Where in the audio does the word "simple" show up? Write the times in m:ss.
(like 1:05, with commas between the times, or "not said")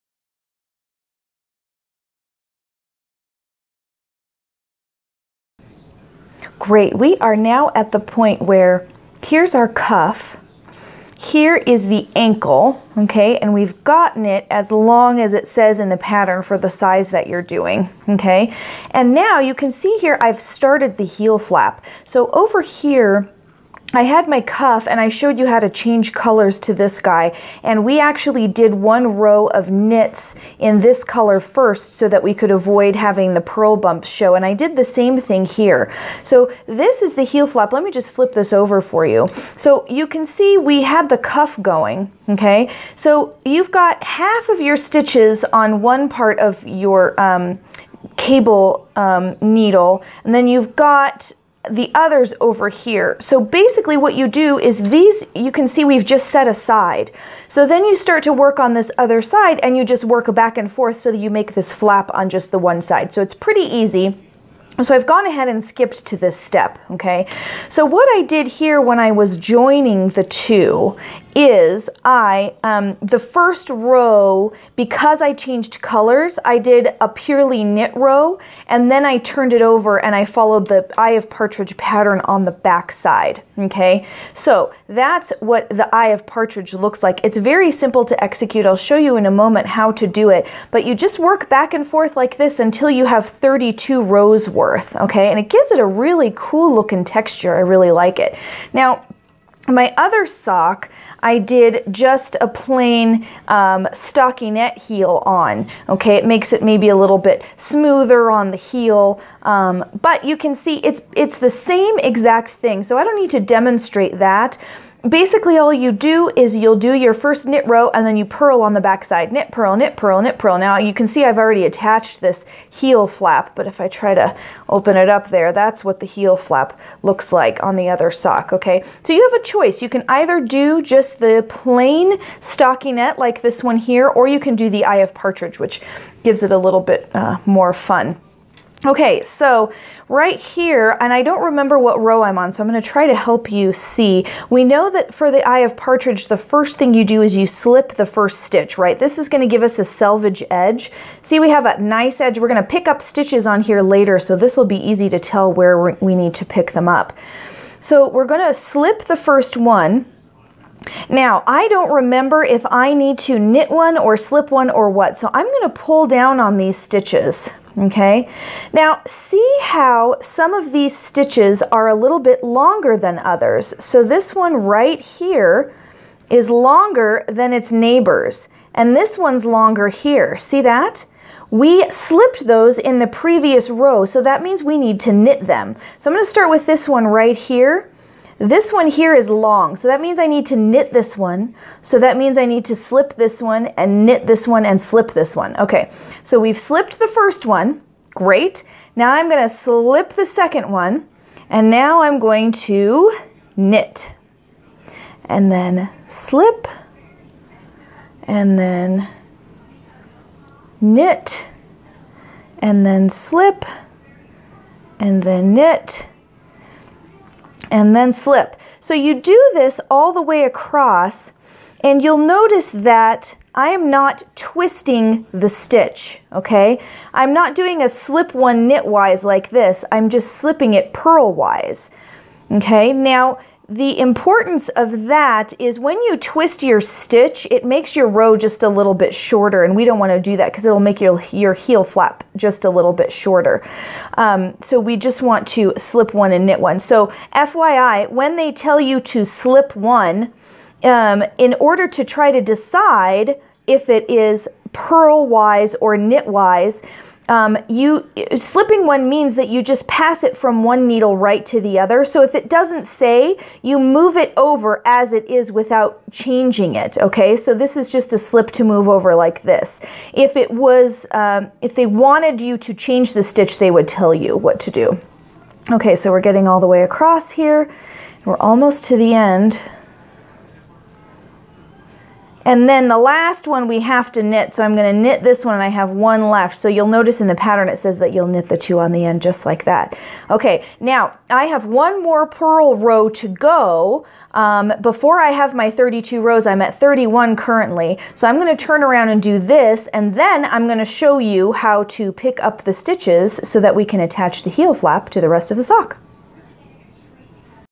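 1:27.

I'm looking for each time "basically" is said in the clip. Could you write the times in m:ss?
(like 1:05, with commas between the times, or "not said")
0:53, 1:55.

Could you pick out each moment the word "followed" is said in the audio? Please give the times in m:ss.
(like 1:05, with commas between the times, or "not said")
1:20.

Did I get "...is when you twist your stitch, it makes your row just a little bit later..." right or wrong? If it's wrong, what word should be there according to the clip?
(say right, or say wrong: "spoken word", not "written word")
wrong: "shorter", not "later".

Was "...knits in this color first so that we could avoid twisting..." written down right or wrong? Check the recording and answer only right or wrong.
wrong.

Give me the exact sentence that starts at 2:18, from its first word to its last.
Okay, so right here, and I don't remember what row I'm on, so I'm gonna try to help you see.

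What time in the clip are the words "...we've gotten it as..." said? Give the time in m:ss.
0:13.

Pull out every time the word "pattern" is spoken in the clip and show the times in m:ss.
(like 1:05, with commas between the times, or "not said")
0:15, 1:21, 4:47.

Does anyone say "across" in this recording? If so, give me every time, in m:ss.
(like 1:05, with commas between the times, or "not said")
3:40, 4:36.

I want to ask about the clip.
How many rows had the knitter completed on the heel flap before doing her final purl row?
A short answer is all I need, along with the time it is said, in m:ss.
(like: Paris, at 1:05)
31, at 4:56.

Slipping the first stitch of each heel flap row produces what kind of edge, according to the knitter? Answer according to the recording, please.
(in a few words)
selvage edge.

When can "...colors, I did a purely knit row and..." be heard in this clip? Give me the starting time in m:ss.
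1:15.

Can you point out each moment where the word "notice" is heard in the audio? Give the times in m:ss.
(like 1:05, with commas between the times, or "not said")
3:42, 4:46.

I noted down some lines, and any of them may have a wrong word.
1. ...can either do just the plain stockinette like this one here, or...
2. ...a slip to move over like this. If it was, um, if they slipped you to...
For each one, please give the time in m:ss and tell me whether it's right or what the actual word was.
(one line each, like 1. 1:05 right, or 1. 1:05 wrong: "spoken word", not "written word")
1. 2:09 right
2. 4:28 wrong: "wanted", not "slipped".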